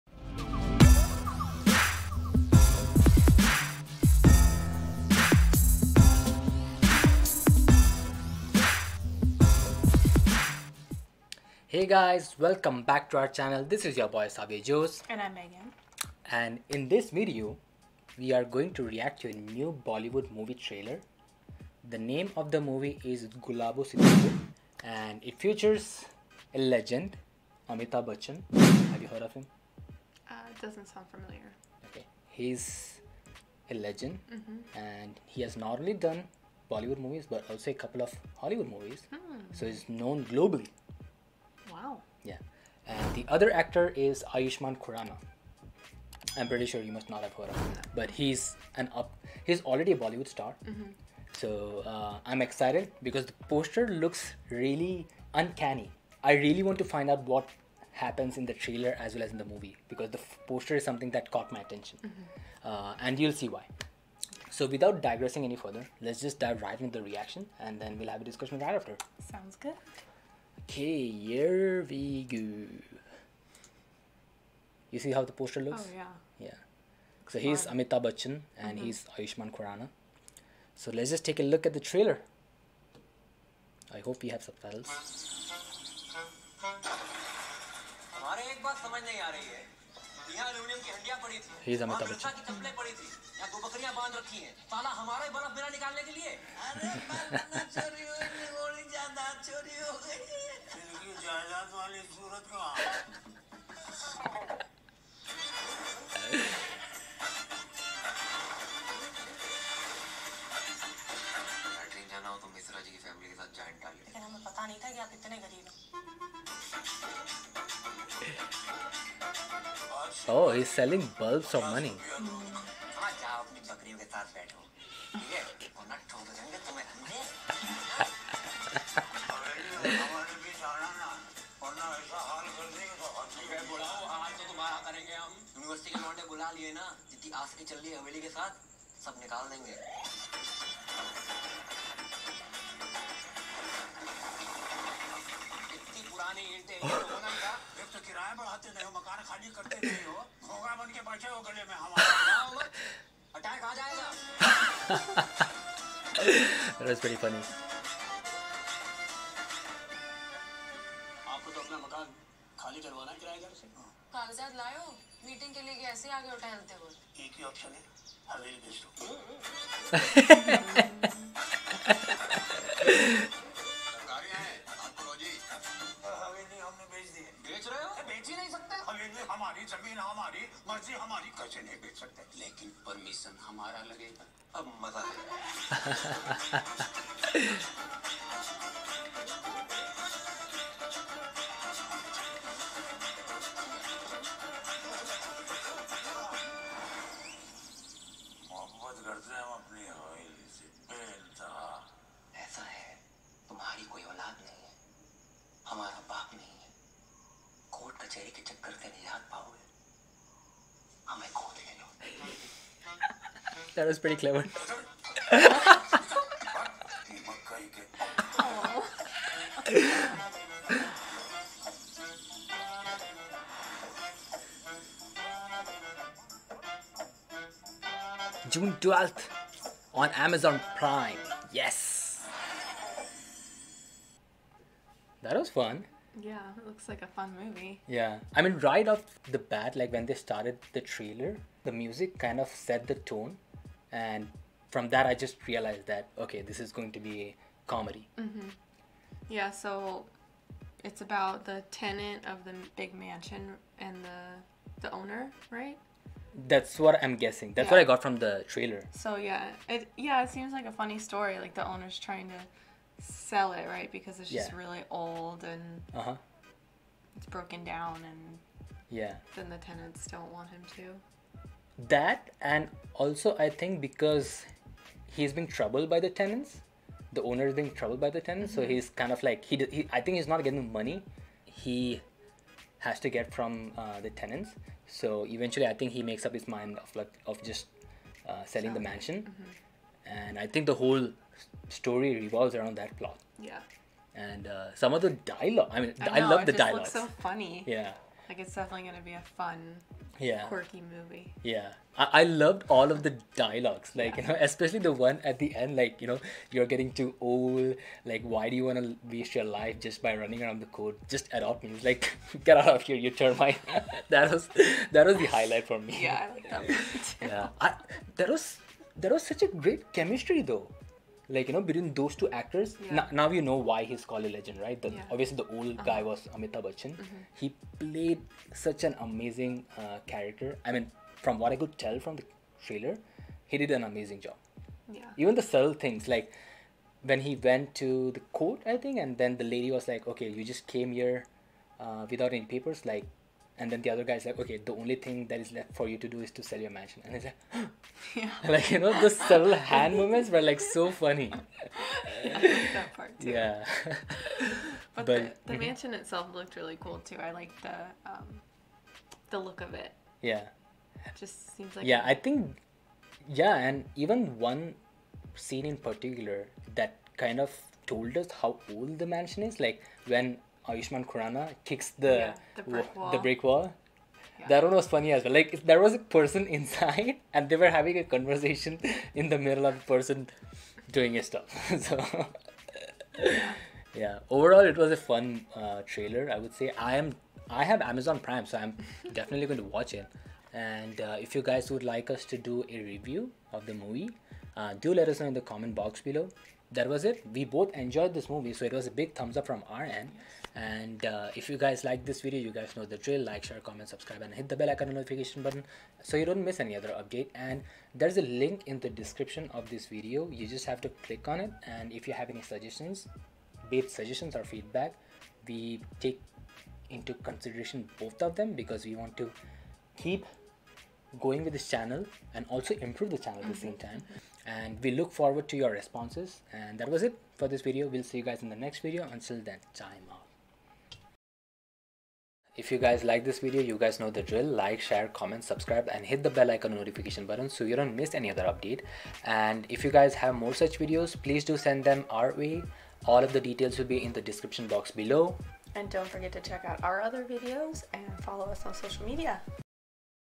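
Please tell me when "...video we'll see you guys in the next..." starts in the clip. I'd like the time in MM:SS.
07:07.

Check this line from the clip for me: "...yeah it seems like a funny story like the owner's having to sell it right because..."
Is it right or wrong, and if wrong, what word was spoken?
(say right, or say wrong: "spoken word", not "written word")
wrong: "trying", not "having".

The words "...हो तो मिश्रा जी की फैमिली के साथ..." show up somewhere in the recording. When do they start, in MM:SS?
01:52.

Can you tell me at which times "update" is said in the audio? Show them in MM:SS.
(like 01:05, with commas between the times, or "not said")
06:46, 07:18.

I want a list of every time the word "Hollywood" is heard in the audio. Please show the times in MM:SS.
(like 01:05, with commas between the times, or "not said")
00:38.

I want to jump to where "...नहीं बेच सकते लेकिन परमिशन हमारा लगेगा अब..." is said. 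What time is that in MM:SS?
03:01.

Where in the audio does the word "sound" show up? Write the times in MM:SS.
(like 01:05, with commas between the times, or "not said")
00:30, 01:09.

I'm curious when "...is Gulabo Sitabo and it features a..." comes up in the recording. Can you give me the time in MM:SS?
00:23.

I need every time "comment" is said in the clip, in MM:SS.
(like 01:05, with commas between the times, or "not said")
06:35, 06:43, 07:15.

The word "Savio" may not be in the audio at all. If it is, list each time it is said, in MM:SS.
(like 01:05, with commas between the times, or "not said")
00:14.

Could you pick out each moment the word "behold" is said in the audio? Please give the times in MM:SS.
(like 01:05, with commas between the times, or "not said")
not said.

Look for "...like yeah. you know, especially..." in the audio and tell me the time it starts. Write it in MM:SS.
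05:03.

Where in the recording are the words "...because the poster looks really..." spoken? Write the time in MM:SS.
00:53.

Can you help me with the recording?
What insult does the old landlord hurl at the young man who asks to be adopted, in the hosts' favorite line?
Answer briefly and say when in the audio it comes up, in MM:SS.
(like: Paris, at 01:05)
termite, at 05:13.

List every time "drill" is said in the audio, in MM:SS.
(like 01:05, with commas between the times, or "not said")
06:42, 07:14.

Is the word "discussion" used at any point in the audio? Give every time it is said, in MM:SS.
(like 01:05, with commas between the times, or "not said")
01:08.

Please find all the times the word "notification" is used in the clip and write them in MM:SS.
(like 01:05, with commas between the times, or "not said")
06:44, 07:16.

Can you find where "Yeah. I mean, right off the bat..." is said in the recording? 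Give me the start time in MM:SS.
03:57.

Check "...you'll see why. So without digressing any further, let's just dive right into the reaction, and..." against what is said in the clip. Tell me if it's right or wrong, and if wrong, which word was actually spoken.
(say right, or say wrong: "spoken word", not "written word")
right.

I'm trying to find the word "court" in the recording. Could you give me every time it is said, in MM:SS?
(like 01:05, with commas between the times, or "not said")
05:10, 05:38.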